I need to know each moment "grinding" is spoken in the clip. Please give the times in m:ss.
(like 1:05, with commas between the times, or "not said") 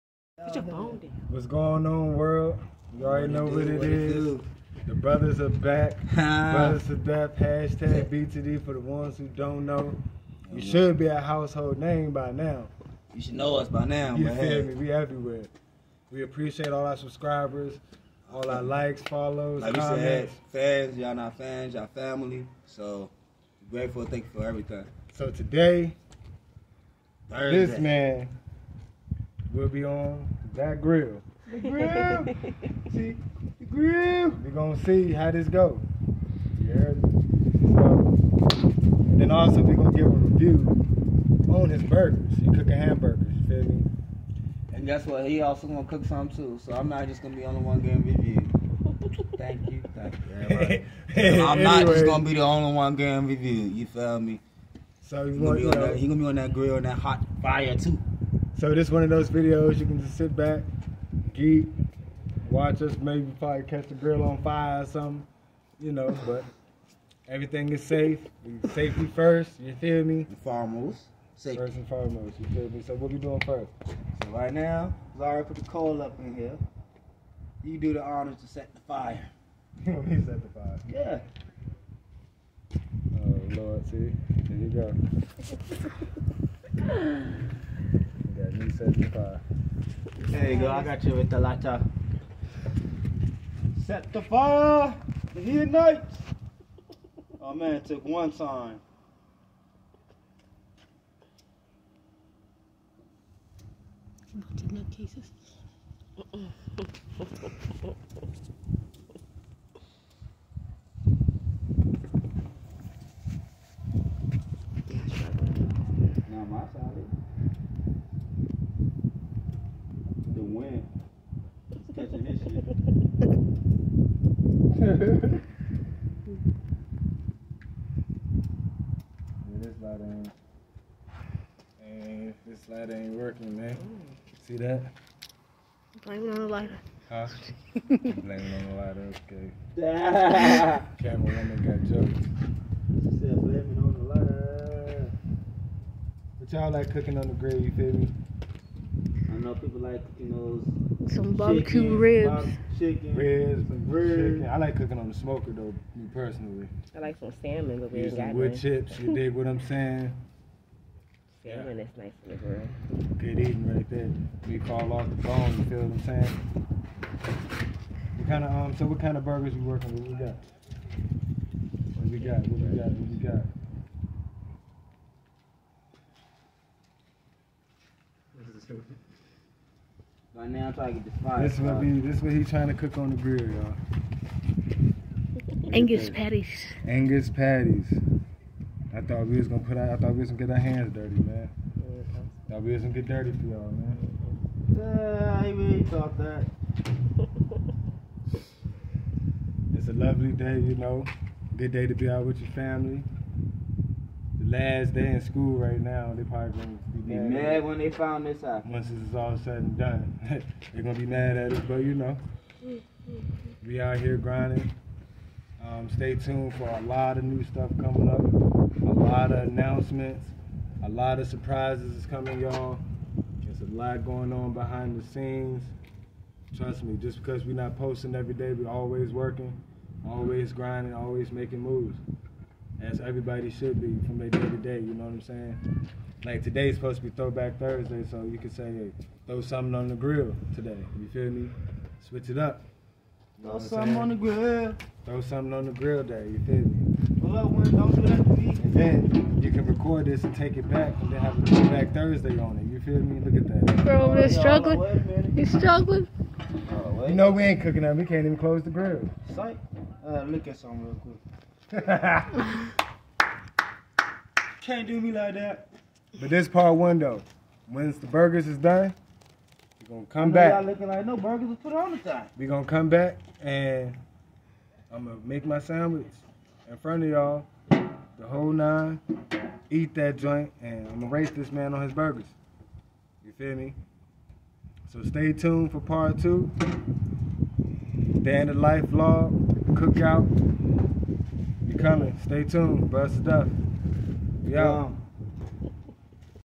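3:34, 3:50.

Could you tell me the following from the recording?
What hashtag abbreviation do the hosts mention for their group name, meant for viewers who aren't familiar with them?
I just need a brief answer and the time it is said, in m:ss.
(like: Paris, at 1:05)
BTD, at 0:08.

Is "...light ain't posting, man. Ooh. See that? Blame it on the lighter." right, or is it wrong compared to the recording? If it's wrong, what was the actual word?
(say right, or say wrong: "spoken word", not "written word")
wrong: "working", not "posting".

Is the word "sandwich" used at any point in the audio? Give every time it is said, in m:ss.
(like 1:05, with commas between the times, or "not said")
4:35.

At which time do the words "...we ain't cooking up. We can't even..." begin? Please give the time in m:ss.
4:17.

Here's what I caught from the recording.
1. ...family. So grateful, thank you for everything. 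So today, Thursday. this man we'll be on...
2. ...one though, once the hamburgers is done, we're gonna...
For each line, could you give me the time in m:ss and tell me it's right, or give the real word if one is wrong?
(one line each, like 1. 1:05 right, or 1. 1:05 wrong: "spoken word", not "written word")
1. 0:21 right
2. 4:26 wrong: "burgers", not "hamburgers".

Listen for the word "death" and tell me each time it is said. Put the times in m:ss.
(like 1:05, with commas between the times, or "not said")
0:06.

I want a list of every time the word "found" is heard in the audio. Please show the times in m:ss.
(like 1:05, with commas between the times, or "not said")
3:27.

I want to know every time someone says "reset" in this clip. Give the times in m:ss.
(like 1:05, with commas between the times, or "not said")
1:28.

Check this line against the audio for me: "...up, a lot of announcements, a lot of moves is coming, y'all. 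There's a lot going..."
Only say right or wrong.
wrong.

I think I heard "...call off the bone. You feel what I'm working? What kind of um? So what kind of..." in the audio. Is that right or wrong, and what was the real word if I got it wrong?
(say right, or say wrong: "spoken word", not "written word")
wrong: "saying", not "working".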